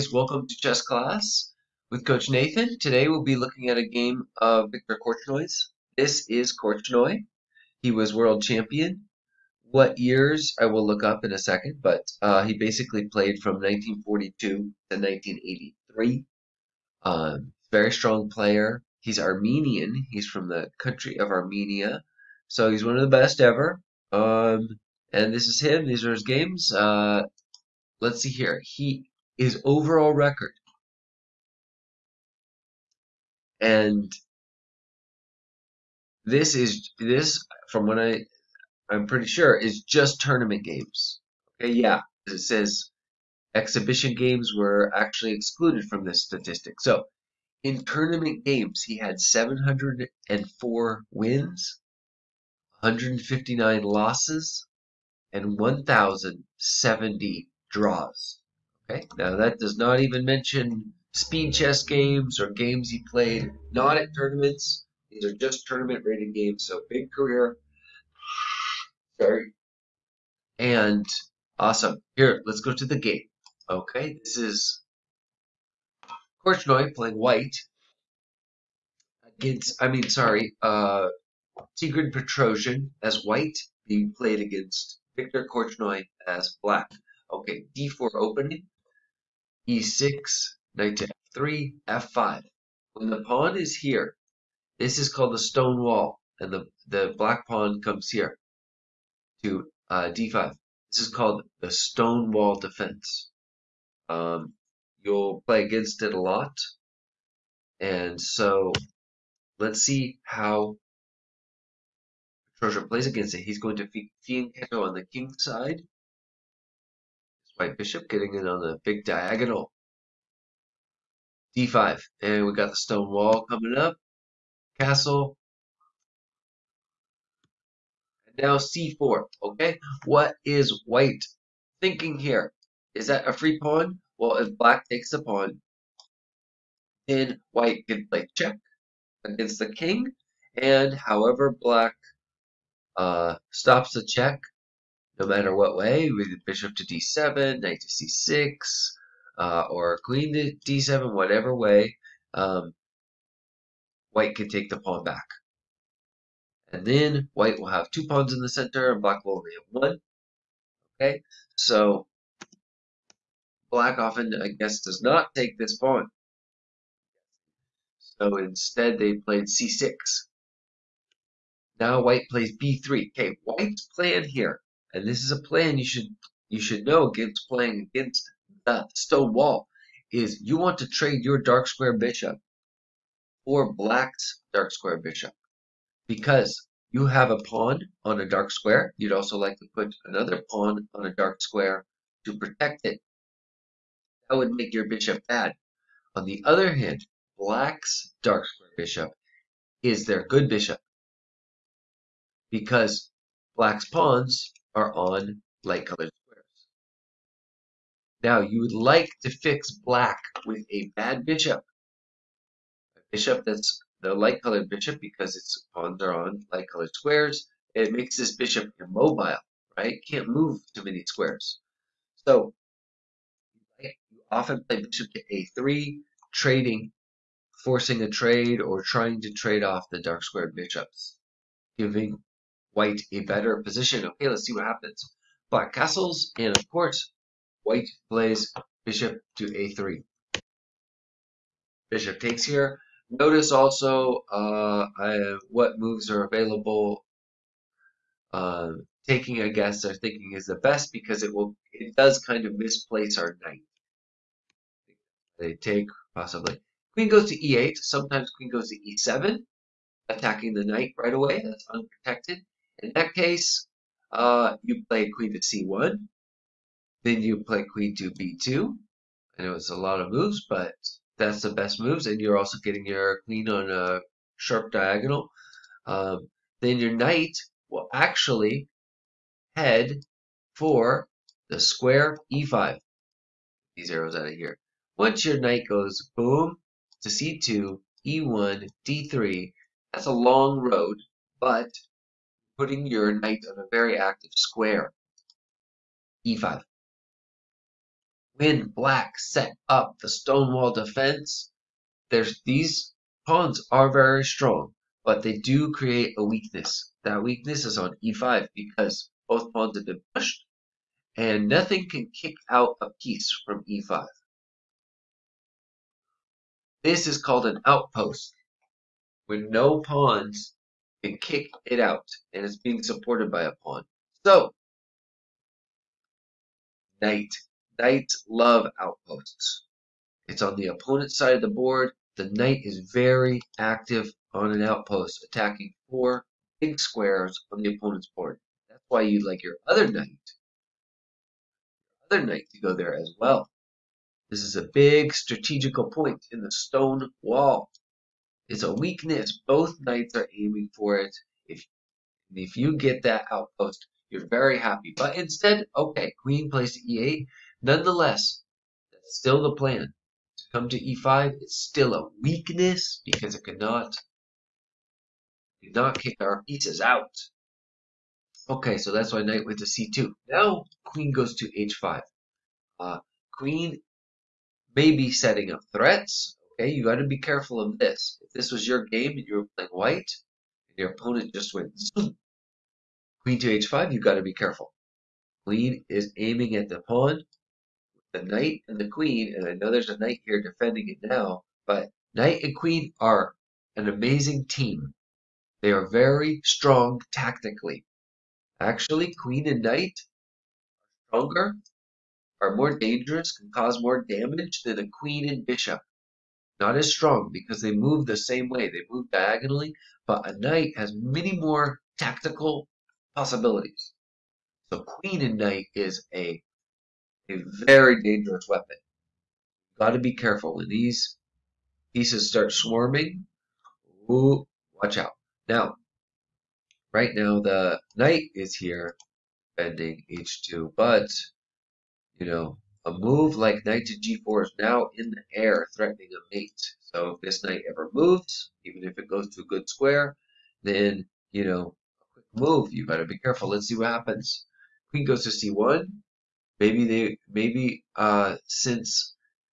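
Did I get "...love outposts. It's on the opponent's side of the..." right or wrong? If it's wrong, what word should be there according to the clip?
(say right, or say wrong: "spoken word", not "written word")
right.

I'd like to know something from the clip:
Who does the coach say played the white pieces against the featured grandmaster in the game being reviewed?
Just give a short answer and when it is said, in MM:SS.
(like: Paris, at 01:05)
Tigran Petrosian, at 01:21.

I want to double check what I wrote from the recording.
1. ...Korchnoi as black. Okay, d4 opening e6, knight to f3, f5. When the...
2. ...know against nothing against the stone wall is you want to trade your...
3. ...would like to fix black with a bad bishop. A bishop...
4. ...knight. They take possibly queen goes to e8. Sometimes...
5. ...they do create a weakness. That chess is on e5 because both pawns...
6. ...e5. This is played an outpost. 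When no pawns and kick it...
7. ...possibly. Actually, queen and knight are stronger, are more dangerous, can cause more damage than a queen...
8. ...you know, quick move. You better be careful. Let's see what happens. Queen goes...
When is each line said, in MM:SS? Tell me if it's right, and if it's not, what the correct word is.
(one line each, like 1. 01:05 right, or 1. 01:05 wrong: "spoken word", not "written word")
1. 01:25 right
2. 02:56 wrong: "playing", not "nothing"
3. 03:28 right
4. 04:13 right
5. 05:05 wrong: "weakness", not "chess"
6. 05:13 wrong: "called", not "played"
7. 06:37 wrong: "tactically", not "possibly"
8. 07:21 right.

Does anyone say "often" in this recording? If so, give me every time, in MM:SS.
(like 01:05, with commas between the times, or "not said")
02:43, 03:44.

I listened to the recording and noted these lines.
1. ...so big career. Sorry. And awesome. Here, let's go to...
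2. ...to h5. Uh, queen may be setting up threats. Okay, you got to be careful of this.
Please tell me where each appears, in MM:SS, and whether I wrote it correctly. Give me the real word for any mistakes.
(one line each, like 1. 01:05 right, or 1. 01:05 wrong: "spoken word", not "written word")
1. 01:06 right
2. 06:11 right.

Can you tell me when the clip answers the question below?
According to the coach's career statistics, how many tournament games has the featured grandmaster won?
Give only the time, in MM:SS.
00:49.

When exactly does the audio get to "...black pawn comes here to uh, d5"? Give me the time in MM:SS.
01:37.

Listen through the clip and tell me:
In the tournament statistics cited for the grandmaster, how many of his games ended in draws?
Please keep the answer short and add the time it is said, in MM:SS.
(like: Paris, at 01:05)
1,070, at 00:55.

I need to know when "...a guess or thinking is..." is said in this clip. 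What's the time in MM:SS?
04:09.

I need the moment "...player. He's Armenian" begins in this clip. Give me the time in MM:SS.
00:18.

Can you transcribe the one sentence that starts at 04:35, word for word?
Um, then your knight will actually head for the square e5.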